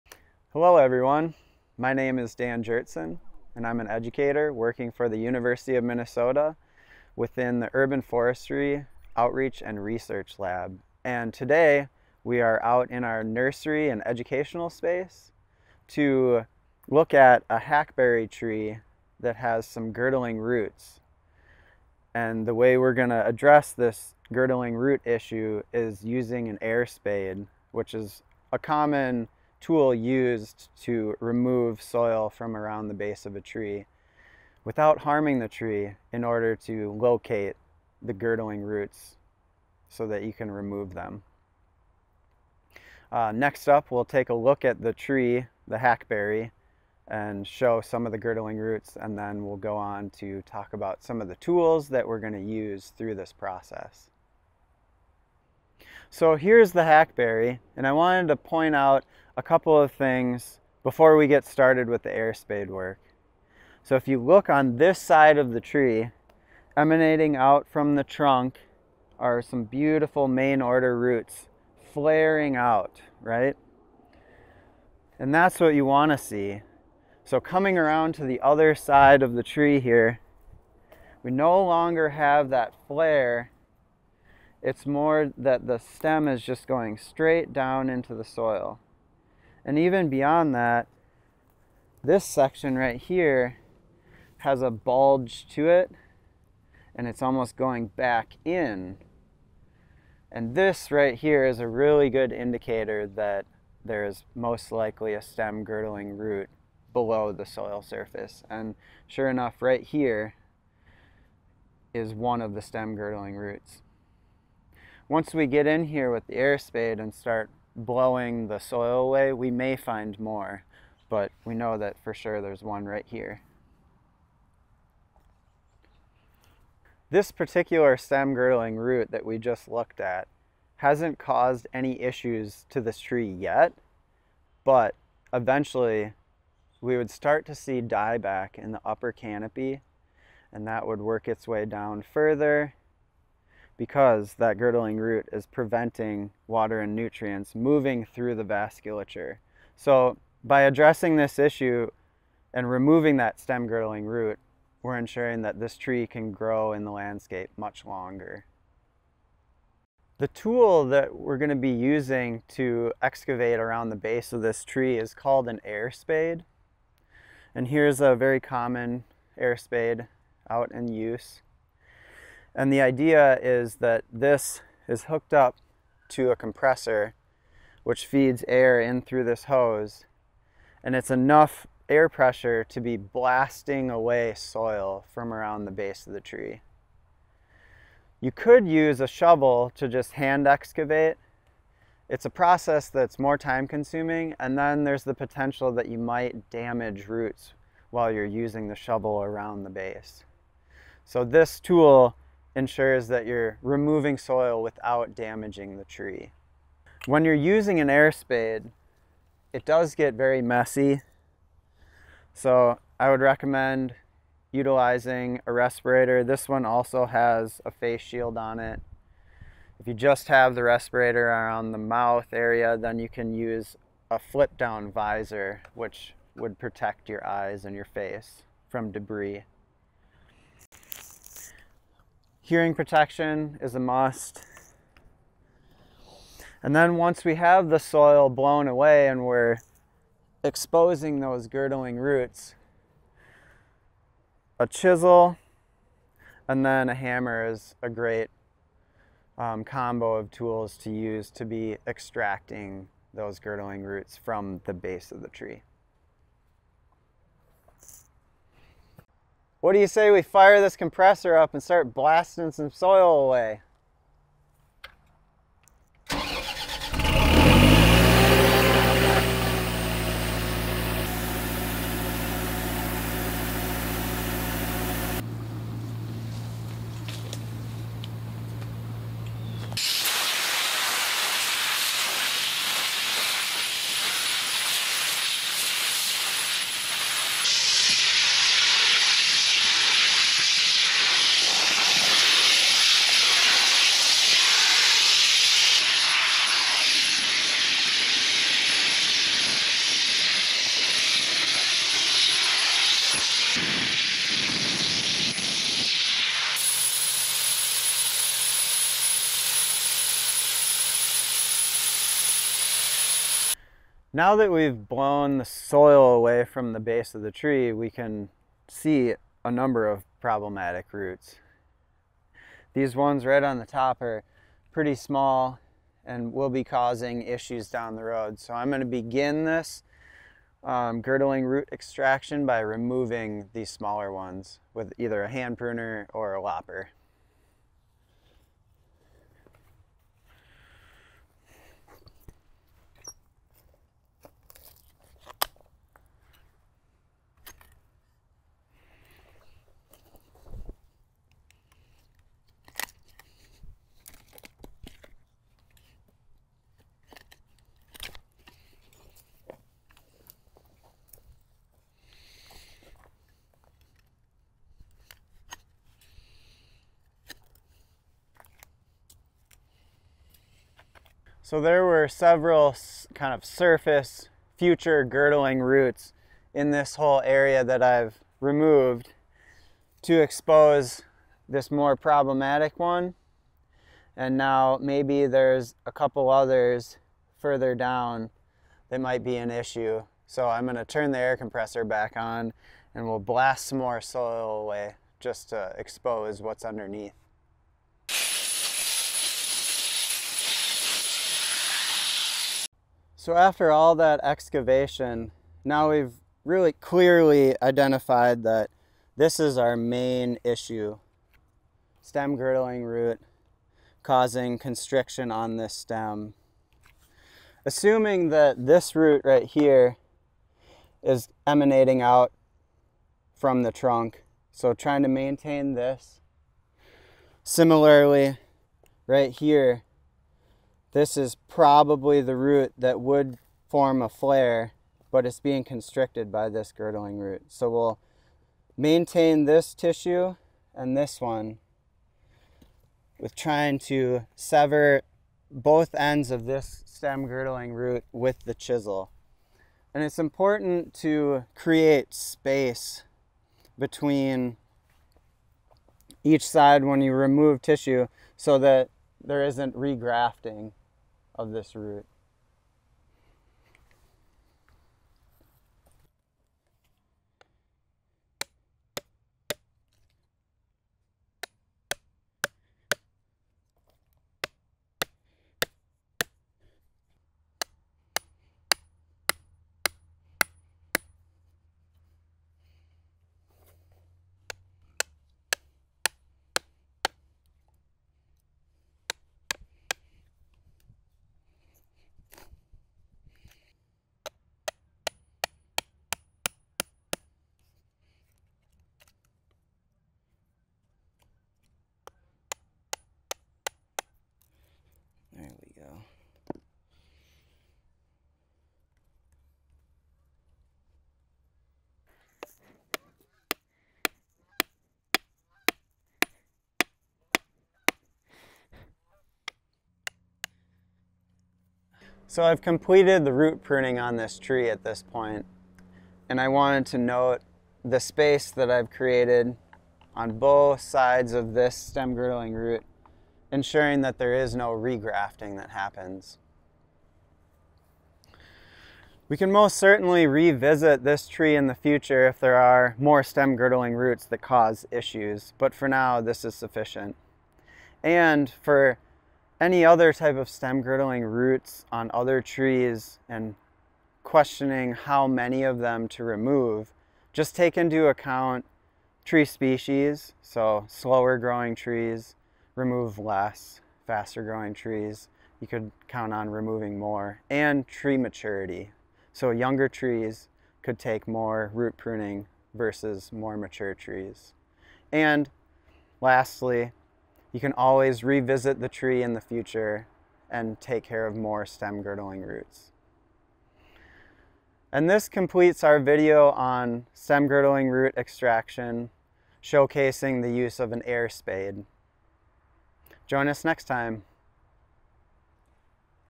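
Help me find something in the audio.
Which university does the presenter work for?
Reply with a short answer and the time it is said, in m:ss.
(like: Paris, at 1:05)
University of Minnesota, at 0:05.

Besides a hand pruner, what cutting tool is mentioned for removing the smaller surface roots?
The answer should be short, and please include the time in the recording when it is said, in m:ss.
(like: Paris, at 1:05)
Lopper, at 5:36.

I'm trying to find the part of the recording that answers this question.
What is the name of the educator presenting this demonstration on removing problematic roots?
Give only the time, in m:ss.
0:02.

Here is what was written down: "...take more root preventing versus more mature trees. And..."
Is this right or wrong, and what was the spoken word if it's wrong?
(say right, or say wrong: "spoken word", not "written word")
wrong: "pruning", not "preventing".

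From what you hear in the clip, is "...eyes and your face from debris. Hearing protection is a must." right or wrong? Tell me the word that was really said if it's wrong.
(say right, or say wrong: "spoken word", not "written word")
right.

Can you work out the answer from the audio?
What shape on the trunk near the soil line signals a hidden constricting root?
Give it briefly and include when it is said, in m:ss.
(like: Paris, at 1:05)
A bulge, at 1:34.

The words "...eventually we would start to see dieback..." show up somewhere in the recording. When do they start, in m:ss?
2:15.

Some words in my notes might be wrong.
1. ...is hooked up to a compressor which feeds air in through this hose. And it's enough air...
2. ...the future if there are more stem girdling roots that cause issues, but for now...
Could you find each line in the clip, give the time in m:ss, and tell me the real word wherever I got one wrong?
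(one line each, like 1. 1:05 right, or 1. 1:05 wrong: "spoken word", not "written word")
1. 2:54 right
2. 9:01 right.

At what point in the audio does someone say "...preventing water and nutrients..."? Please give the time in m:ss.
2:25.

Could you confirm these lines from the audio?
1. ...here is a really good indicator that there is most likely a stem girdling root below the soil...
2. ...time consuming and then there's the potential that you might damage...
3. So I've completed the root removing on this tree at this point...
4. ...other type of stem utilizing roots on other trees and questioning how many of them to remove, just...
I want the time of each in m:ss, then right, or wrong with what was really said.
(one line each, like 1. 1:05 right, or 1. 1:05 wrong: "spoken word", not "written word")
1. 1:41 right
2. 3:13 right
3. 8:42 wrong: "pruning", not "removing"
4. 9:09 wrong: "girdling", not "utilizing".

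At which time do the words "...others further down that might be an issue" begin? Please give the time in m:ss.
6:26.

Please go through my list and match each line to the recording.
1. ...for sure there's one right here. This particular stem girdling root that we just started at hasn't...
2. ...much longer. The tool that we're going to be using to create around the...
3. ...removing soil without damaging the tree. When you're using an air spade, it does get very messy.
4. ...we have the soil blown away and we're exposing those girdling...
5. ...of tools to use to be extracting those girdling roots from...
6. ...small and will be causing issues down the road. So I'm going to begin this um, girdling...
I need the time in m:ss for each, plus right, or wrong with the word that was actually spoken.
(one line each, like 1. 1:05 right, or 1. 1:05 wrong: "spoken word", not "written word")
1. 2:02 wrong: "looked", not "started"
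2. 2:37 wrong: "excavate", not "create"
3. 3:23 right
4. 3:57 right
5. 4:10 right
6. 5:24 right.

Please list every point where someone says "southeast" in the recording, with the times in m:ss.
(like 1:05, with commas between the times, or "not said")
not said.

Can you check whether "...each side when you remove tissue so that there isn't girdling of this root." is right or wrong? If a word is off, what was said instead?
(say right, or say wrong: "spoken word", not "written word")
wrong: "regrafting", not "girdling".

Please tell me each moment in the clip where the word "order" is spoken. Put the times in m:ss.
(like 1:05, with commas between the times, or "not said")
0:36, 1:10.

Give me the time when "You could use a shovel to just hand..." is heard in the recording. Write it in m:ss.
3:08.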